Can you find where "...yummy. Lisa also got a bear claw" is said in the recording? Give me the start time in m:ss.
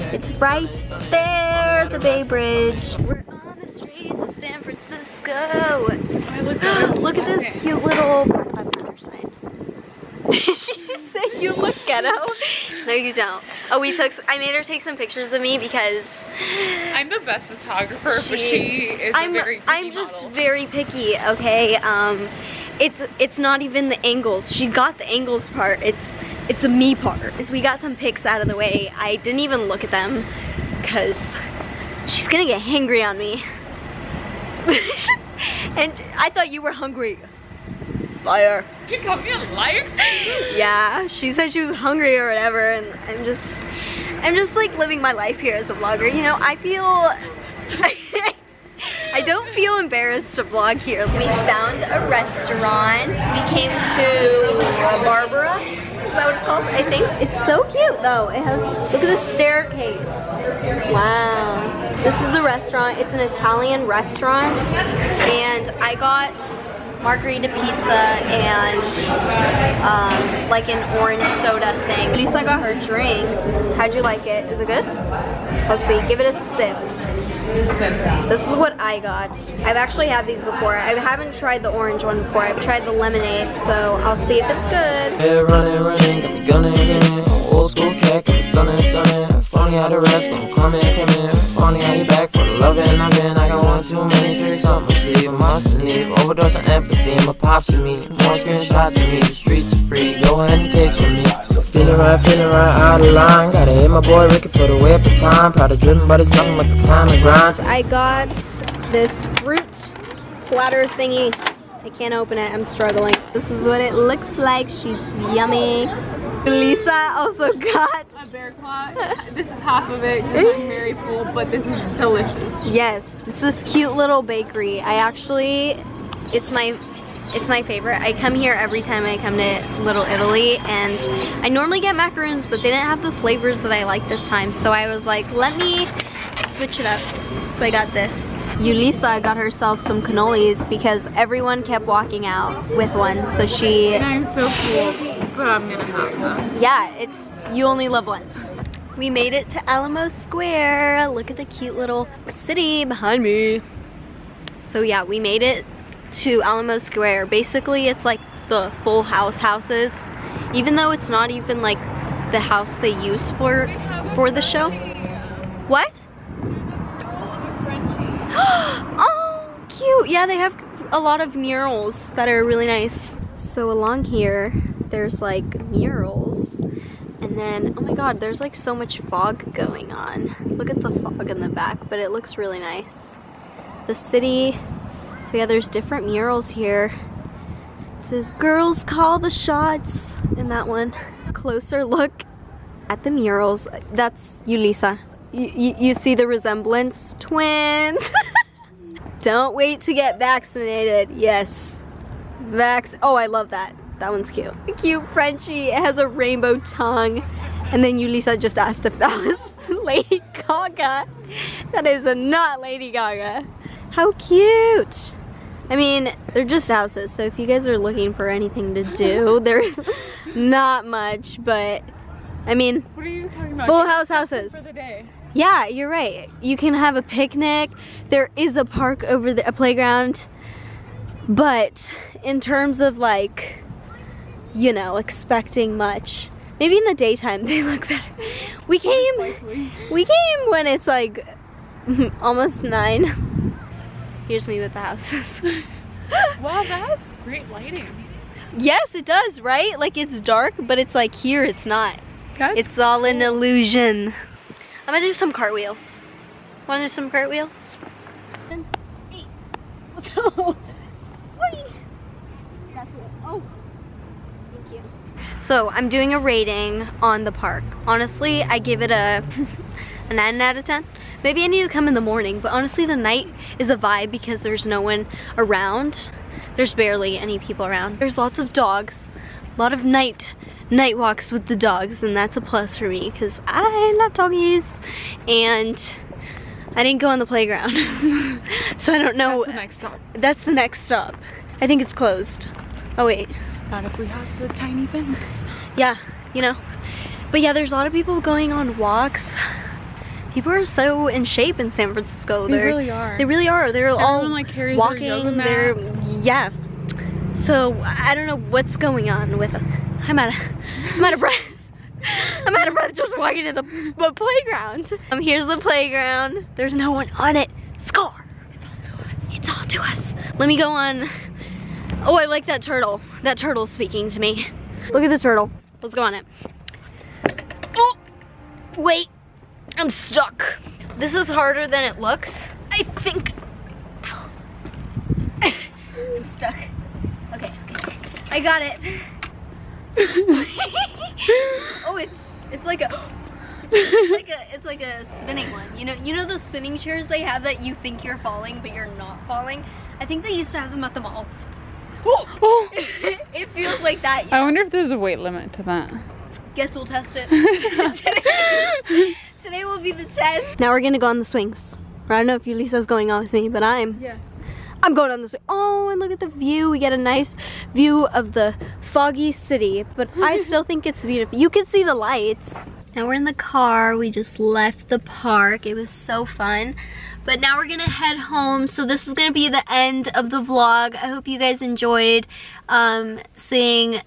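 1:55.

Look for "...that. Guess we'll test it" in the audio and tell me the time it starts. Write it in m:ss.
5:55.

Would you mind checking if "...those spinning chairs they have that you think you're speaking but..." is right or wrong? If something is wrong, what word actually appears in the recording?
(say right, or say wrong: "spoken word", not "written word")
wrong: "falling", not "speaking".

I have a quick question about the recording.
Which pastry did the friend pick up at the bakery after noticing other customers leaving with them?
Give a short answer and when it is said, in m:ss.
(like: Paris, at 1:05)
Cannolis, at 2:20.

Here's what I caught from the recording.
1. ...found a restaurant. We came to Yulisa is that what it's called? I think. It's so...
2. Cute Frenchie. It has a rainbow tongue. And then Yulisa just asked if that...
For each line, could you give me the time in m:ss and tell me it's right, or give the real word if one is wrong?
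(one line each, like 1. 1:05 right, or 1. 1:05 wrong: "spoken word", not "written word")
1. 0:51 wrong: "Barbara", not "Yulisa"
2. 3:24 right.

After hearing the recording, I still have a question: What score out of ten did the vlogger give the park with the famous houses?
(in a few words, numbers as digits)
9.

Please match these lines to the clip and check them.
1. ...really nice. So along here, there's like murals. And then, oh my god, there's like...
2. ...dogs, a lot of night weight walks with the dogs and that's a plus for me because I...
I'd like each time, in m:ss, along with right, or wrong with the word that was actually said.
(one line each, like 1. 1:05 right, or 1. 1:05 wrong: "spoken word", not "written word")
1. 2:52 right
2. 4:38 wrong: "night", not "weight".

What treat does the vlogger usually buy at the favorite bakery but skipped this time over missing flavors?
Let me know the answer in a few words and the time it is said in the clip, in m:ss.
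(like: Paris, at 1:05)
Macaroons, at 2:11.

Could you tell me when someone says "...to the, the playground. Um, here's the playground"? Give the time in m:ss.
5:13.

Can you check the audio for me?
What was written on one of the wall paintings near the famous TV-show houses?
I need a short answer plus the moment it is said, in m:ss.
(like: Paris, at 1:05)
Girls call the shots, at 3:08.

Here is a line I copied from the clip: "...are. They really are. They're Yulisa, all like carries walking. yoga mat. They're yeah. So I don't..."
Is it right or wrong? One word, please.
wrong.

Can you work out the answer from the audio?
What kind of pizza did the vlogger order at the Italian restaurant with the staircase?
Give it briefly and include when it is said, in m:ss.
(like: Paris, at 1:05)
Margarita pizza, at 1:07.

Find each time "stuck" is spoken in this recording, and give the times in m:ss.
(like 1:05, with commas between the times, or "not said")
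5:29, 5:36.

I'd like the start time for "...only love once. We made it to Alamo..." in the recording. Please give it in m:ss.
2:27.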